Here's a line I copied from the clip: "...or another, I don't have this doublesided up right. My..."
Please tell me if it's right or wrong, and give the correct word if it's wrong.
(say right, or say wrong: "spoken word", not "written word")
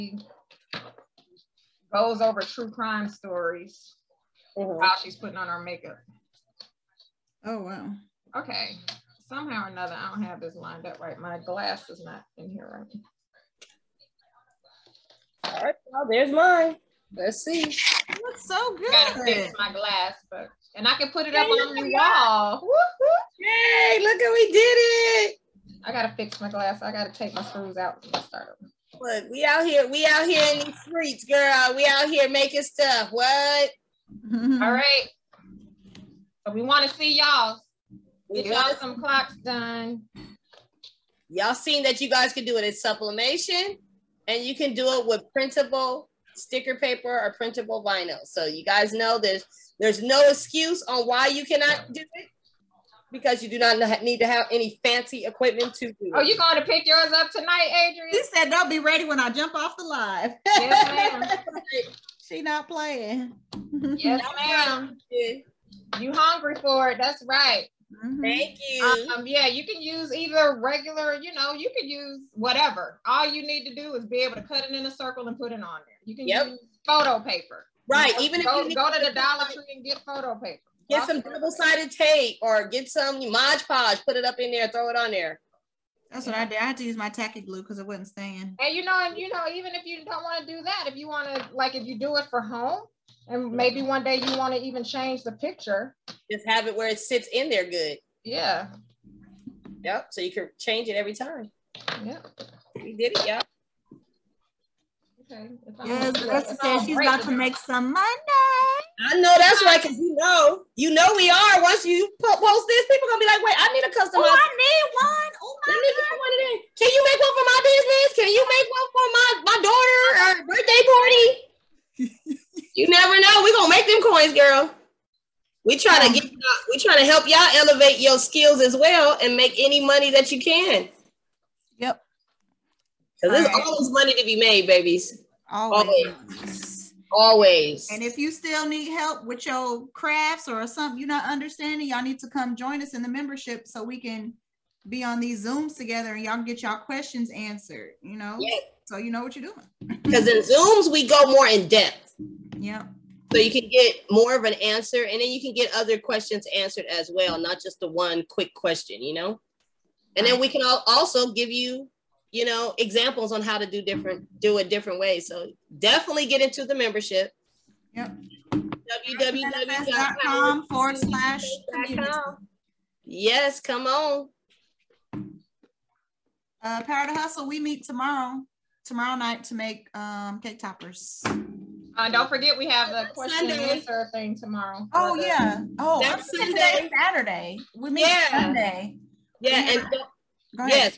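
wrong: "lined", not "doublesided".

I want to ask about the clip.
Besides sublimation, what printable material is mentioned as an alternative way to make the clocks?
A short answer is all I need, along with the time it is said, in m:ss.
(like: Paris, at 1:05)
printable sticker paper, at 0:45.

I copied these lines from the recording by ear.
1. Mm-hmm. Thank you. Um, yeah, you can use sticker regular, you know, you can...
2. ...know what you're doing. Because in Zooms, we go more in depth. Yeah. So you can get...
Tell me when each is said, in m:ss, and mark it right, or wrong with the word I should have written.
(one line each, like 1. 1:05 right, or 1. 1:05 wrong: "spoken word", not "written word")
1. 1:08 wrong: "either", not "sticker"
2. 2:29 right.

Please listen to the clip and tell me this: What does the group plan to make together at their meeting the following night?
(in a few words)
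cake toppers.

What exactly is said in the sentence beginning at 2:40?
And then we can all also give you, you know, examples on how to do different, do it different ways.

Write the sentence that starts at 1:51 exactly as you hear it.
Once you post this, people gonna be like, "Wait, I need a customized." Oh, I need one.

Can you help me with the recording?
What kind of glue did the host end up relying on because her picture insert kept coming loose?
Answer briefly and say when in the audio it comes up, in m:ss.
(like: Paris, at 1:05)
tacky glue, at 1:27.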